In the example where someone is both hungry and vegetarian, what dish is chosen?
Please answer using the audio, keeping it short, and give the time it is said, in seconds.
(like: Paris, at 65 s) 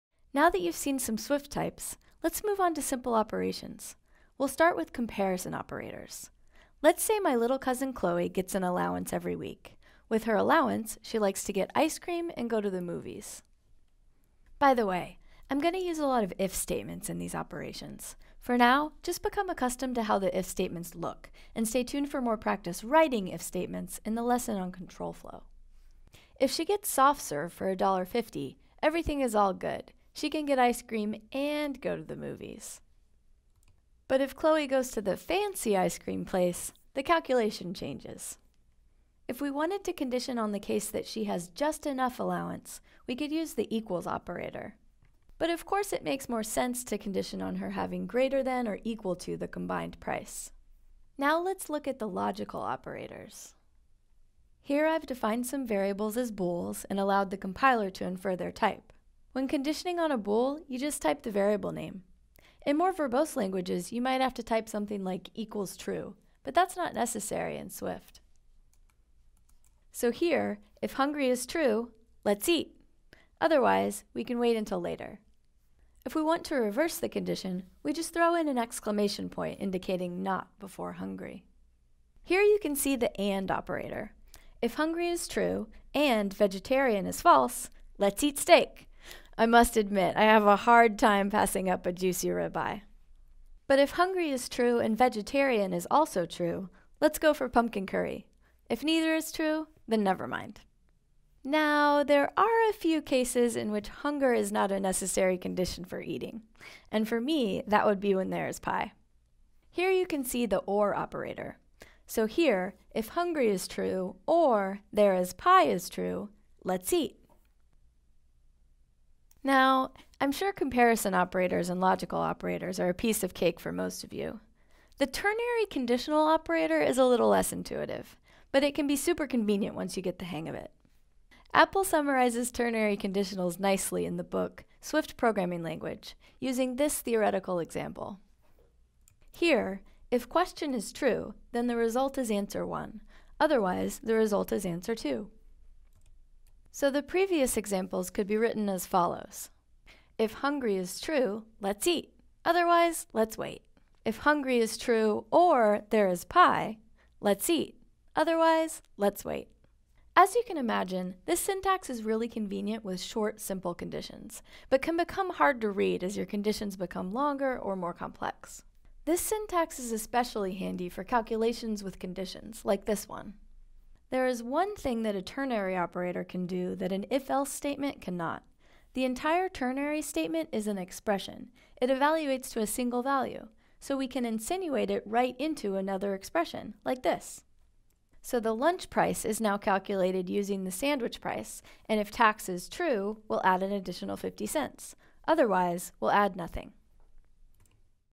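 pumpkin curry, at 97 s.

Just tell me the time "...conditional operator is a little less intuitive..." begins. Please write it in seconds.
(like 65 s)
125 s.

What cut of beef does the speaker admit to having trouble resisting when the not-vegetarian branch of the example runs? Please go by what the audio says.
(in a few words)
ribeye.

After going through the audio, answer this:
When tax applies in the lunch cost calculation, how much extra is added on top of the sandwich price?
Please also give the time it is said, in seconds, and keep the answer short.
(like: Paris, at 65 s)
50 cents, at 194 s.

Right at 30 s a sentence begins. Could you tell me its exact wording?
She can get ice cream and go to the movies.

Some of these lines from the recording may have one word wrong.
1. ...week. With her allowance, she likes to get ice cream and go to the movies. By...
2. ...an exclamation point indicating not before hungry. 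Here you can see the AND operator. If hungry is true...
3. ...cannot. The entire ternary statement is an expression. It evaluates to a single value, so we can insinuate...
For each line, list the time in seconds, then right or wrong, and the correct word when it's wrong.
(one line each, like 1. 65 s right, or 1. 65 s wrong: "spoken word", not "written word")
1. 9 s right
2. 78 s right
3. 178 s right.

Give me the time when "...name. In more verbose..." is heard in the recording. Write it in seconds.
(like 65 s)
61 s.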